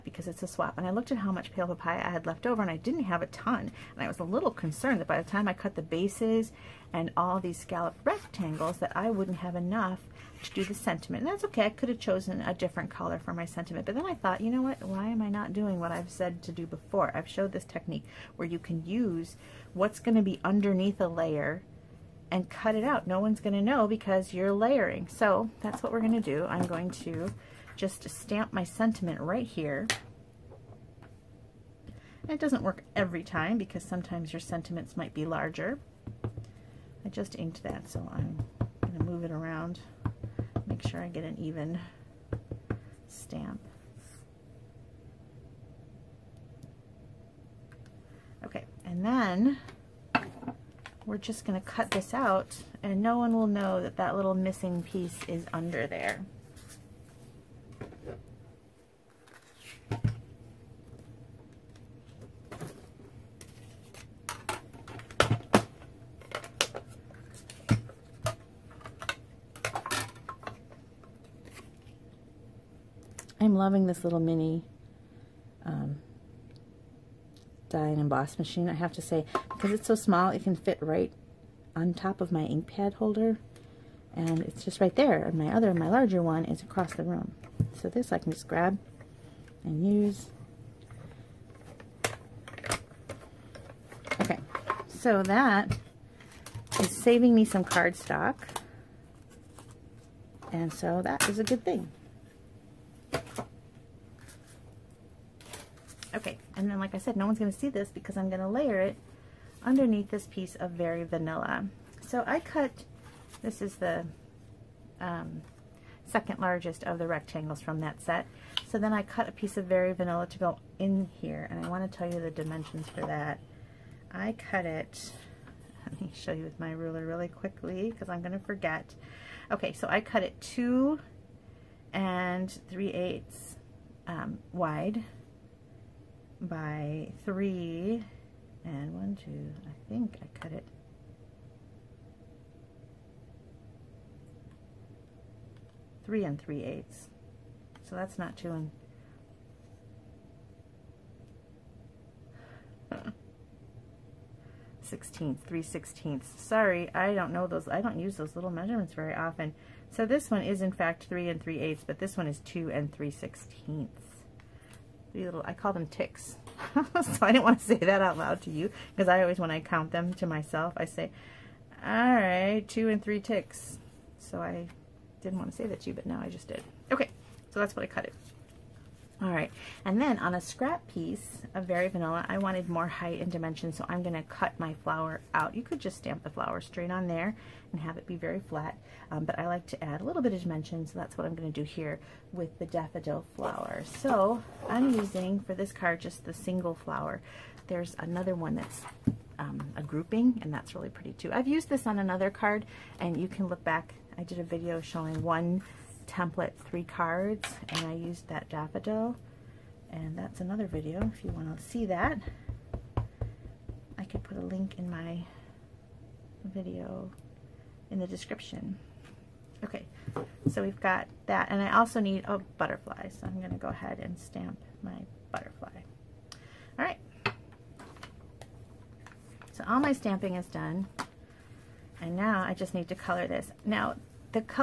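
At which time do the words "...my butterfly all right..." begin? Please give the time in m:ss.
3:44.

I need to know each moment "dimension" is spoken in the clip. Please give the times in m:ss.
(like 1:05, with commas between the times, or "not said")
2:02, 3:03, 3:10.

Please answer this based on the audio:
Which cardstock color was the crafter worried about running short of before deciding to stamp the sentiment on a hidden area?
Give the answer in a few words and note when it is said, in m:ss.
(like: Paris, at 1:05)
Pale Papaya, at 0:01.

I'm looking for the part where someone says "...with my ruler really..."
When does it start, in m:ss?
2:06.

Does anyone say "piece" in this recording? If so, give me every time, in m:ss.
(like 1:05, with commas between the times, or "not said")
0:54, 1:50, 1:59, 3:00.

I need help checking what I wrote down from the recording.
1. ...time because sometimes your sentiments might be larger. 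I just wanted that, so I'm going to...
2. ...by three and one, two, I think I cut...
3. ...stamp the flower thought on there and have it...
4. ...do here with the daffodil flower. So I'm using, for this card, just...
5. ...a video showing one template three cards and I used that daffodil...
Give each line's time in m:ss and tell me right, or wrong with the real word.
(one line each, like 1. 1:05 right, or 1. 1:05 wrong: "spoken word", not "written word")
1. 0:33 wrong: "inked", not "wanted"
2. 2:16 right
3. 3:05 wrong: "straight", not "thought"
4. 3:11 right
5. 3:24 right.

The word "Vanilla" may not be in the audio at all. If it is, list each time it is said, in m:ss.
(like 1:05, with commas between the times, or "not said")
1:51, 1:59, 3:01.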